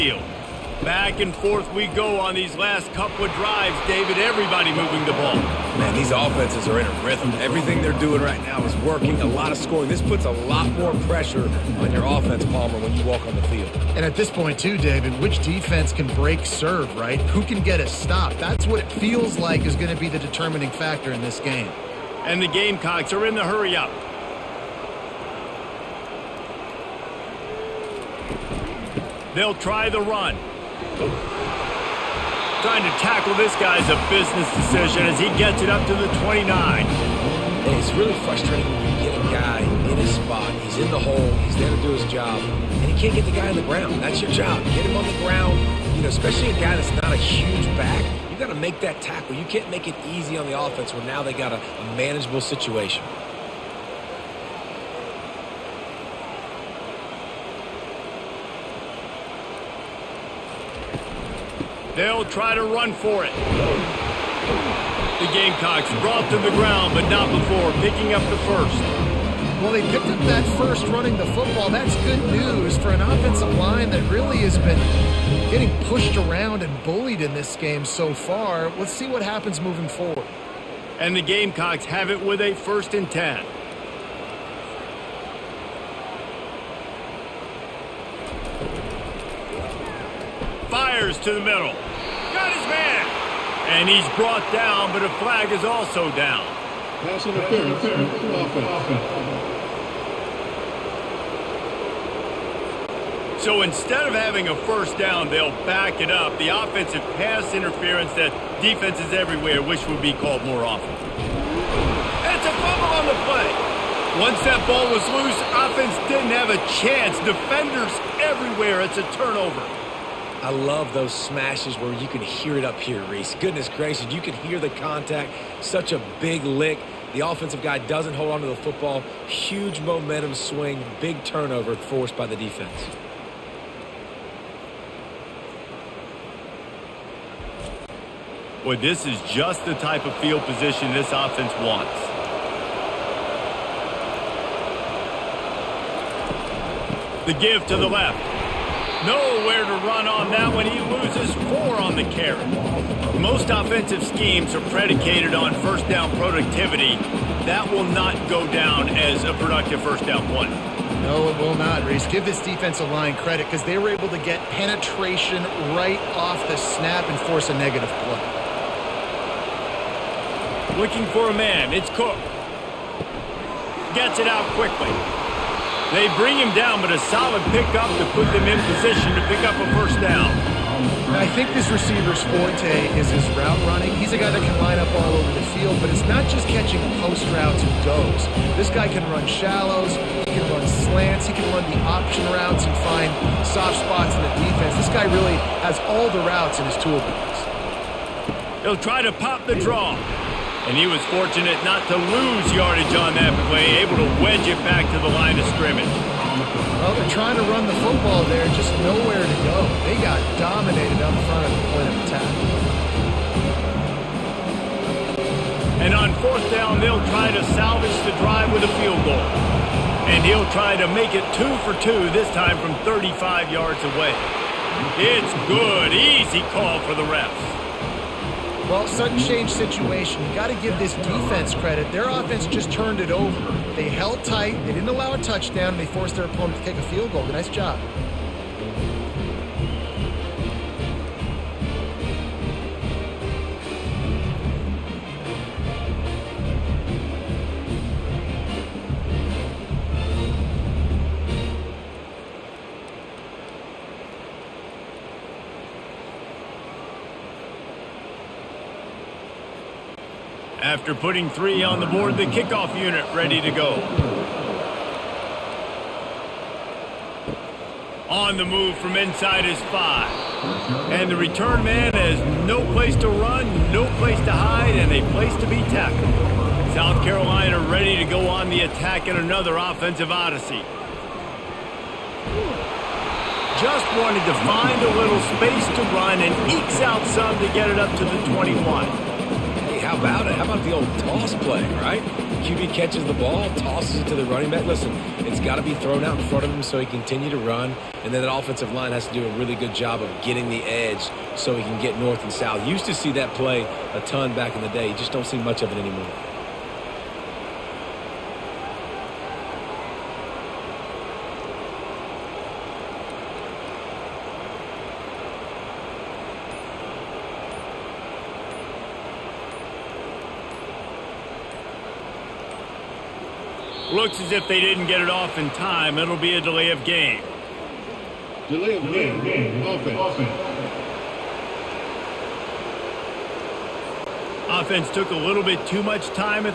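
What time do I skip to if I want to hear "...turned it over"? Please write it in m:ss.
3:52.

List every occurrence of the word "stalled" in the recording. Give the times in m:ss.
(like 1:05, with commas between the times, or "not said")
not said.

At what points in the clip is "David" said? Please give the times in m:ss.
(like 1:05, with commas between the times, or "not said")
0:03, 0:14.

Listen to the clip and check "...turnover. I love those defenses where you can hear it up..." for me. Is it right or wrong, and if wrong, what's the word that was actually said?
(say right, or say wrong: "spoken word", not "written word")
wrong: "smashes", not "defenses".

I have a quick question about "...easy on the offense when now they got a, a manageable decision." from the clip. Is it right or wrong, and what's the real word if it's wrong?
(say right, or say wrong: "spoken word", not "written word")
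wrong: "situation", not "decision".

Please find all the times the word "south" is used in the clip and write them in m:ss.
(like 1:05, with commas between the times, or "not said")
4:36, 5:02.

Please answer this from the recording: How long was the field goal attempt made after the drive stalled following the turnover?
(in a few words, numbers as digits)
35 yards.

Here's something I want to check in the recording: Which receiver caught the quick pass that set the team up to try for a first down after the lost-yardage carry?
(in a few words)
Cook.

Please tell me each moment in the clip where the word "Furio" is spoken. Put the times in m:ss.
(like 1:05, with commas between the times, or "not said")
not said.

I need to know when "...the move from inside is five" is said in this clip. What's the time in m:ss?
4:28.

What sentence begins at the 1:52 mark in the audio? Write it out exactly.
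That's a fumble on the play.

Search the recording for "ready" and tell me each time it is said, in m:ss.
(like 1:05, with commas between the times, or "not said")
4:23, 4:37.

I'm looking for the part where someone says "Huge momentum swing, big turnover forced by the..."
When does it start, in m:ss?
2:09.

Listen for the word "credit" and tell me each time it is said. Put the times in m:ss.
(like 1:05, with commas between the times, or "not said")
2:43, 3:51.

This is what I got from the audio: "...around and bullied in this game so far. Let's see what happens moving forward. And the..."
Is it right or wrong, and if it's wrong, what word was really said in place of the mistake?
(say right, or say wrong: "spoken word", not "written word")
right.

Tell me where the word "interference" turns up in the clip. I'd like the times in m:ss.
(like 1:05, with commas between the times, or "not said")
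1:37, 1:47.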